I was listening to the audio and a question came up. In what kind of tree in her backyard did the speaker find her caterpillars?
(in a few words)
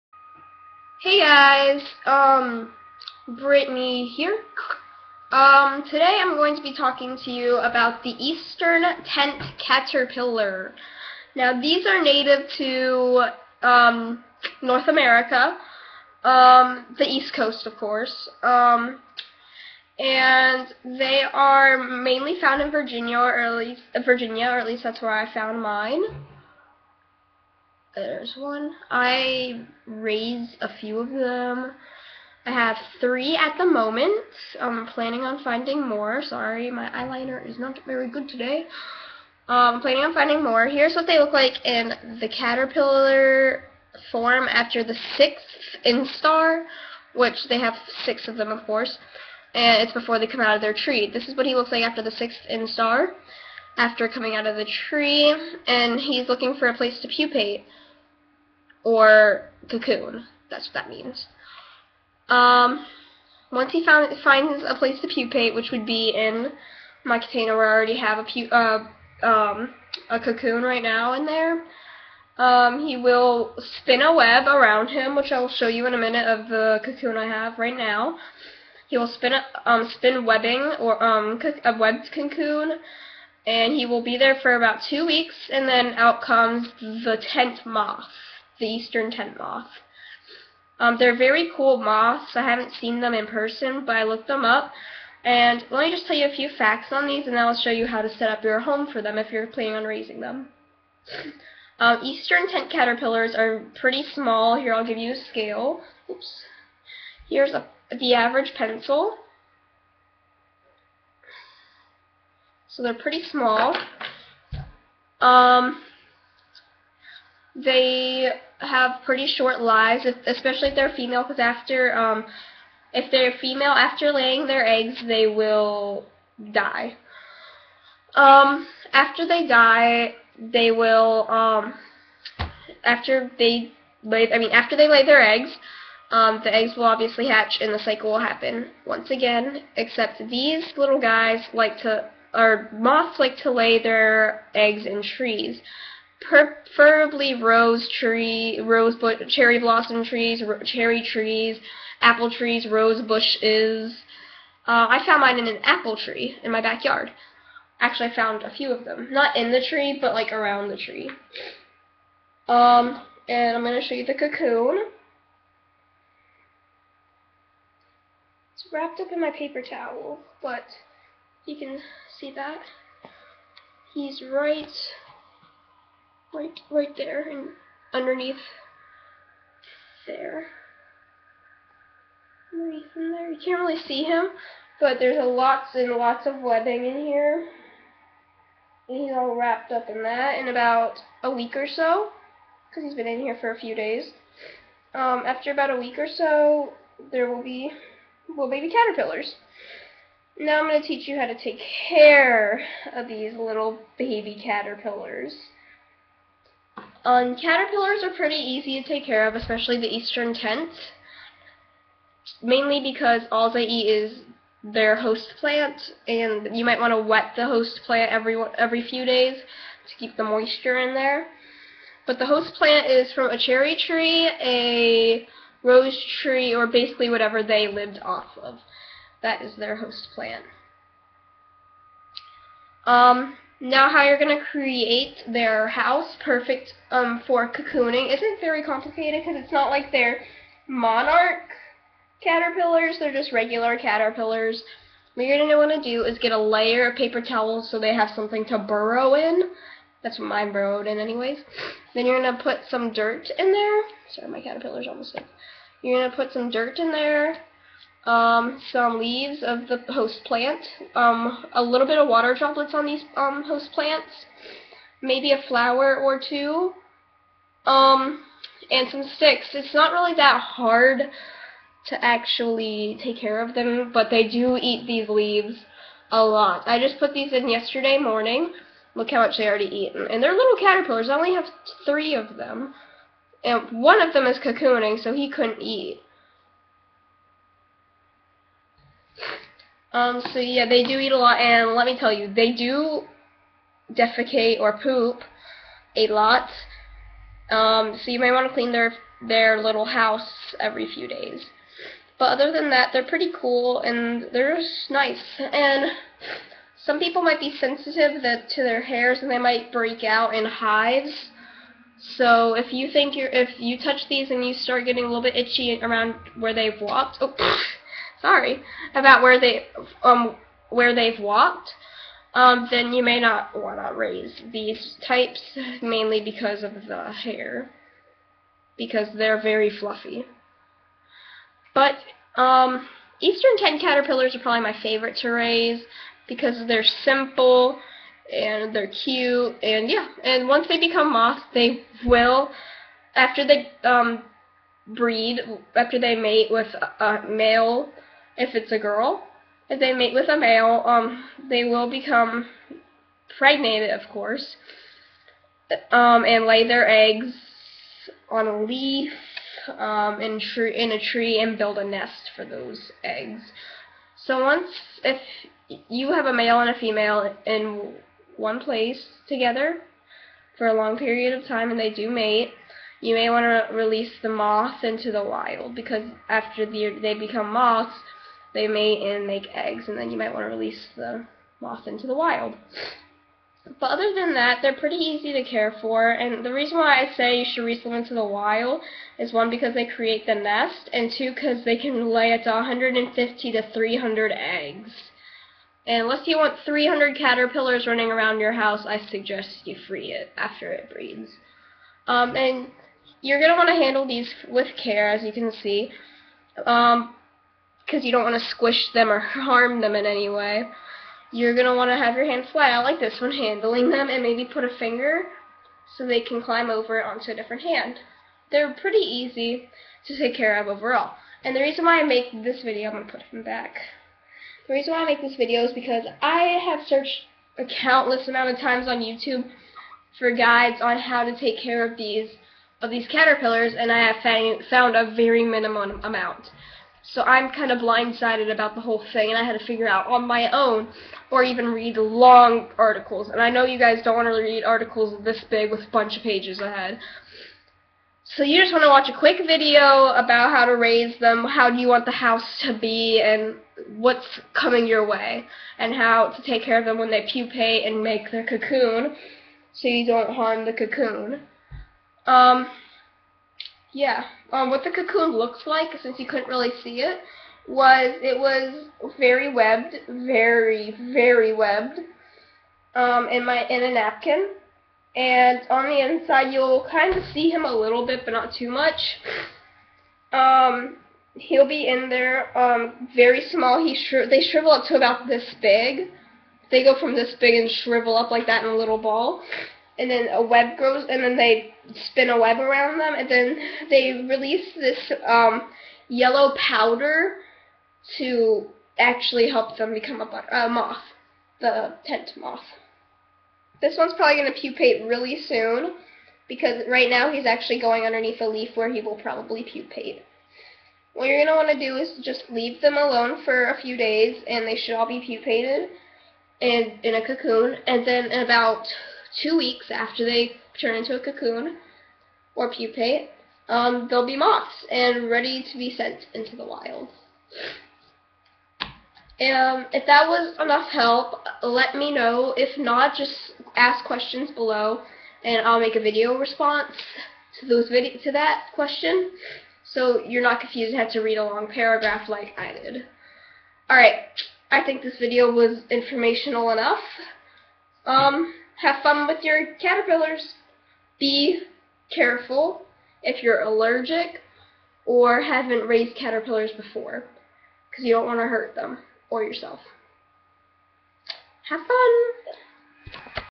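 Apple tree.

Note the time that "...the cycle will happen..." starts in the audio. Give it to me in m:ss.
2:17.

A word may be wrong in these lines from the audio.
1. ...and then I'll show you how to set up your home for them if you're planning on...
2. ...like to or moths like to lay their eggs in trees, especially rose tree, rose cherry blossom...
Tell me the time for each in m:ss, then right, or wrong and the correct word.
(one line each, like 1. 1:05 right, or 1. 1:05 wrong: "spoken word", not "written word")
1. 1:37 right
2. 2:21 wrong: "preferably", not "especially".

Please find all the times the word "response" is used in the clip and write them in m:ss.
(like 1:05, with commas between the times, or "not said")
8:56.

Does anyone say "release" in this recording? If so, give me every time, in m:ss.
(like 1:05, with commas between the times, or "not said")
6:13, 6:20, 6:27, 8:14.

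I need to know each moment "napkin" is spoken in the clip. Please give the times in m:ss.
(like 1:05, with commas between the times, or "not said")
7:53.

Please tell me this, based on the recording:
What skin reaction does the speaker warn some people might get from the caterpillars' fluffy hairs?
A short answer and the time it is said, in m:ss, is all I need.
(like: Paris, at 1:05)
Hives, at 5:10.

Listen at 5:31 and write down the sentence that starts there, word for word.
But um, Eastern Tent caterpillars are probably my favorite to raise because they're simple and they're cute and yeah.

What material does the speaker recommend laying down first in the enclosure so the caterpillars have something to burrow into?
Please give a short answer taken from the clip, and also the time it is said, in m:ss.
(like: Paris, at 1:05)
Paper towels, at 4:06.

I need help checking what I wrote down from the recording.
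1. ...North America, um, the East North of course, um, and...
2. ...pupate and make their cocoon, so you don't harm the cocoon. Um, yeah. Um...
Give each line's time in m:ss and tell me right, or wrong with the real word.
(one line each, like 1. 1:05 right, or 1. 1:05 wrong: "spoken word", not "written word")
1. 0:14 wrong: "Coast", not "North"
2. 7:37 right.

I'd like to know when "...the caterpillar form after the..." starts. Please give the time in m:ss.
0:42.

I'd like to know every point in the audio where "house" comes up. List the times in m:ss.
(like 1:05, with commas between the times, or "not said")
3:55, 4:59, 6:38, 7:32.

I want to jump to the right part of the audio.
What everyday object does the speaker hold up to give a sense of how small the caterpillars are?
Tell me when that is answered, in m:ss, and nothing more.
1:48.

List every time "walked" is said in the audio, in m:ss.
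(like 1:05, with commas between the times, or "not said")
5:16, 5:21.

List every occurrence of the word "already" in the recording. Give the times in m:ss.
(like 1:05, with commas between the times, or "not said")
1:07, 4:39.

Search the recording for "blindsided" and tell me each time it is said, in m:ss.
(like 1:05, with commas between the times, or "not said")
7:17.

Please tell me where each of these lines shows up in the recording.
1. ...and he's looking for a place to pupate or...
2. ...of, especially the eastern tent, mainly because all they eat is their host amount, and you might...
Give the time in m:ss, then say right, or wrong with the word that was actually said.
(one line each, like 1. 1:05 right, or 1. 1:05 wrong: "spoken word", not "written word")
1. 0:55 right
2. 3:29 wrong: "plant", not "amount".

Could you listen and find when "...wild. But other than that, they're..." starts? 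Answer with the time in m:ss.
6:22.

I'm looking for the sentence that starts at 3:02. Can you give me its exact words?
Underneath there, you can't really see him, but there's a lots and lots of webbing in here.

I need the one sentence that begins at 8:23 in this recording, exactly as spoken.
This one's probably going to pupate really soon, because right now he's actually going underneath a leaf where he will probably pupate.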